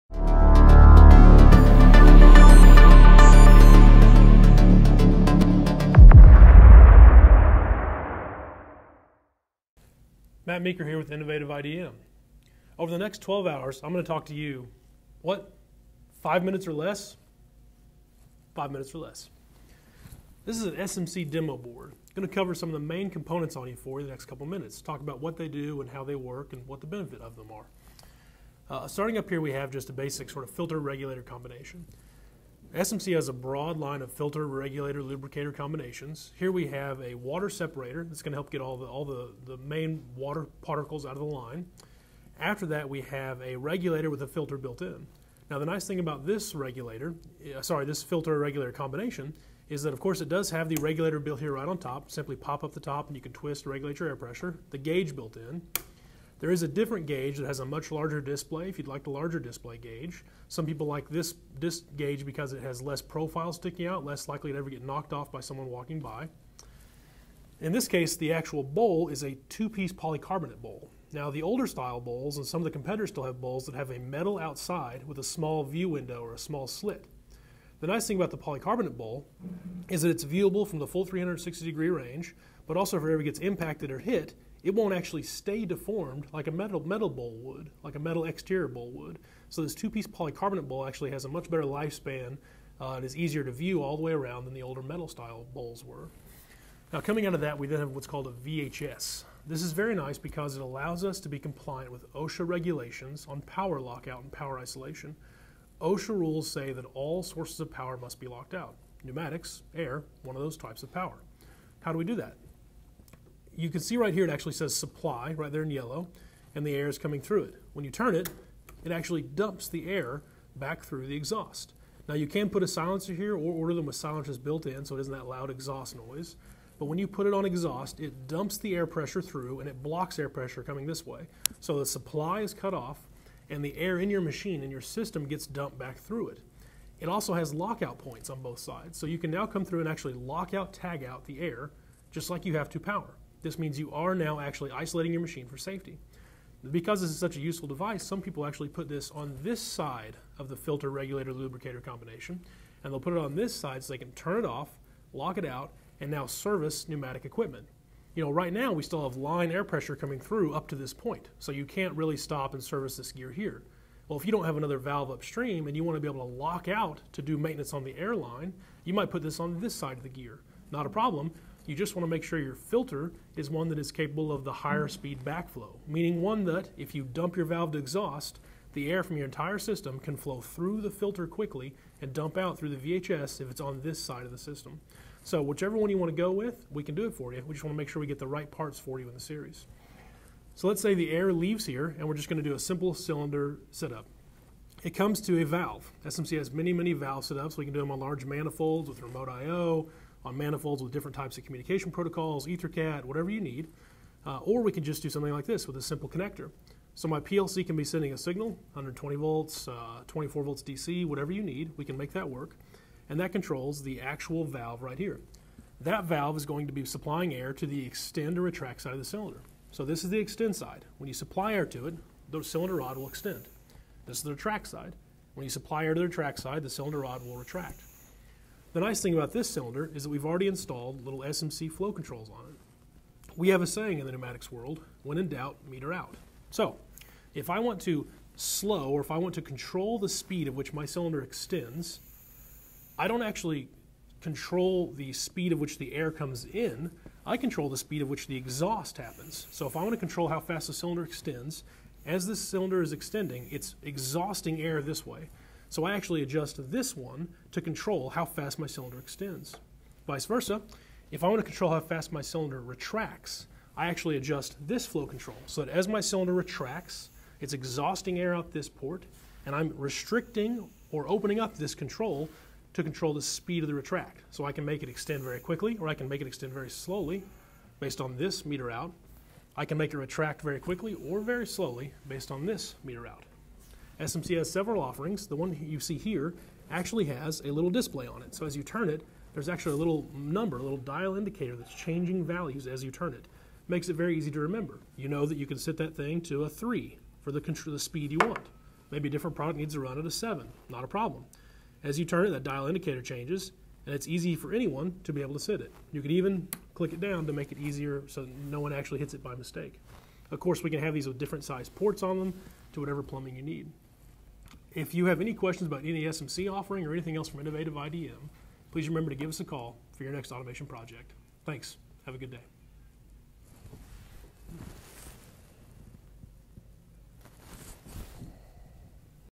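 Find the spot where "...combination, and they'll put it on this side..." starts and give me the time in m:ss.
2:31.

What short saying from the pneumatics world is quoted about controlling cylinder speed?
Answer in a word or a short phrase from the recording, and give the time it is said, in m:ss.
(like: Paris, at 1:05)
When in doubt, meter out, at 3:55.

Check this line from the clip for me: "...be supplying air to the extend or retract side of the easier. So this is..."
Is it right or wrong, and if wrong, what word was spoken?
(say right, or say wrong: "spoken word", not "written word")
wrong: "cylinder", not "easier".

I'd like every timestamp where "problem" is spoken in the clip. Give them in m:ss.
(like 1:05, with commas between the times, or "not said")
2:50, 5:00.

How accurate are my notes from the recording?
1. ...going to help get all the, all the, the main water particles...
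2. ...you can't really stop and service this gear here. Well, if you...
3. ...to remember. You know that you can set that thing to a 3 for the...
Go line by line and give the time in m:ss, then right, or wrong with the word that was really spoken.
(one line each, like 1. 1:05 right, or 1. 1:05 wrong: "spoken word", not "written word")
1. 0:38 right
2. 2:41 right
3. 4:54 right.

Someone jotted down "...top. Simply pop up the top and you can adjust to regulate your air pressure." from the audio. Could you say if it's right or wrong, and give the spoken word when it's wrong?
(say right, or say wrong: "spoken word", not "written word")
wrong: "twist", not "adjust".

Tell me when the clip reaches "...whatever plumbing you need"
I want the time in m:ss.
5:12.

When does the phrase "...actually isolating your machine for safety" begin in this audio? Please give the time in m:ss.
2:24.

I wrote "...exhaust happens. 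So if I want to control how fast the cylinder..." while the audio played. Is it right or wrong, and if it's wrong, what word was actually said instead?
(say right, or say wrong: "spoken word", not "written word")
right.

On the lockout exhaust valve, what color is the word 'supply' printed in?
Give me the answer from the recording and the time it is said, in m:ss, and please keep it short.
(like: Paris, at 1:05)
Yellow, at 1:55.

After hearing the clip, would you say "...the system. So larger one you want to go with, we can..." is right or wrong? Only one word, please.
wrong.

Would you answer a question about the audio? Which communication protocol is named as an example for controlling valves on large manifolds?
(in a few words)
EtherCAT.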